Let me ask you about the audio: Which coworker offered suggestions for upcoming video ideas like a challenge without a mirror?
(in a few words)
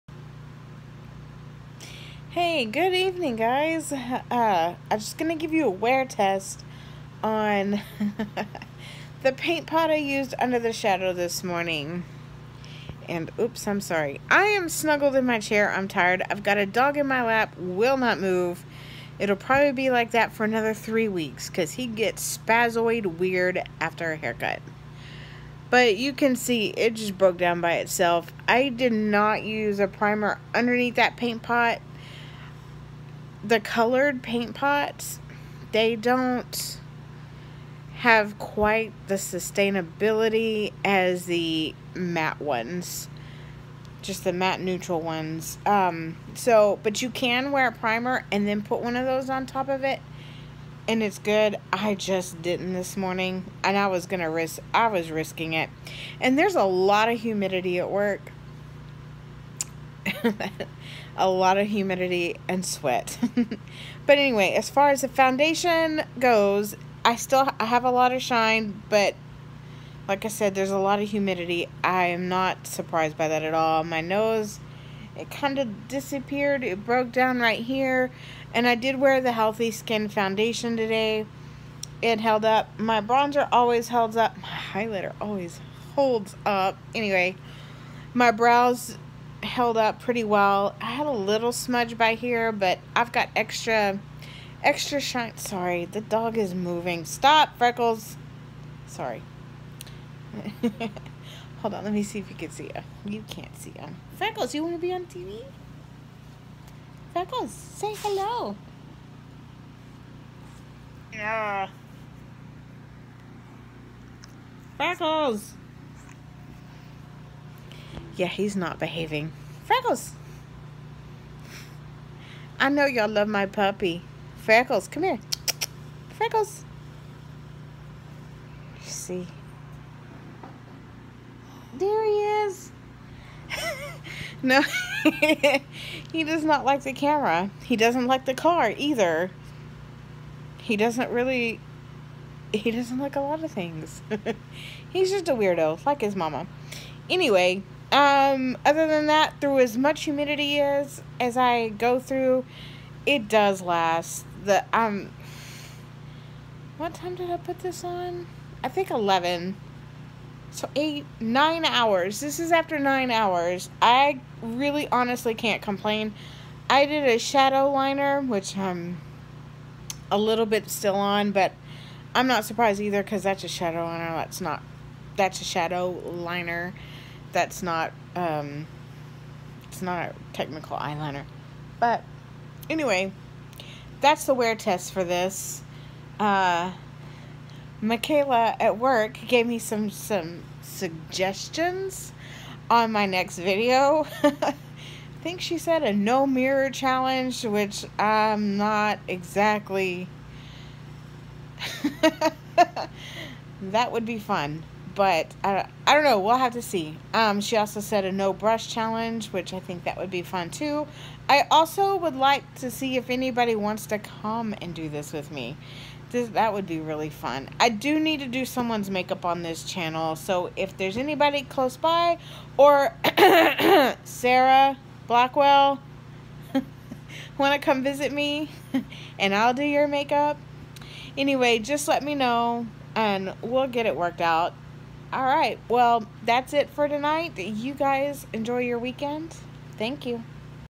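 Michaela.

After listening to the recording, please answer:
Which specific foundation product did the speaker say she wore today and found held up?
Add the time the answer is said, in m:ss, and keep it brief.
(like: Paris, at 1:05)
Healthy Skin Foundation, at 1:19.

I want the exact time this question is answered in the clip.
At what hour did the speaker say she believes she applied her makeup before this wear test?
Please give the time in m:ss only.
2:38.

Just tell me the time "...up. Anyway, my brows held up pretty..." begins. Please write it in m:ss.
1:26.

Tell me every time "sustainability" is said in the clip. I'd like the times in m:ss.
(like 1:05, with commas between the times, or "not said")
0:39.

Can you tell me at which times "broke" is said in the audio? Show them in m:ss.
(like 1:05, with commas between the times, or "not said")
0:27, 1:16.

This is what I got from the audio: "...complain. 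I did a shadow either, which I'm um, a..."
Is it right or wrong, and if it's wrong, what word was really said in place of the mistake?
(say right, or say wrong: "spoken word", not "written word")
wrong: "liner", not "either".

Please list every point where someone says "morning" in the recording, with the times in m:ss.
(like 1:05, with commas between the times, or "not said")
0:11, 0:52.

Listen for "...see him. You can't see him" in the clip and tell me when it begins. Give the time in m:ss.
1:42.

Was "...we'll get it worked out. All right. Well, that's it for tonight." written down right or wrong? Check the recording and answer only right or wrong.
right.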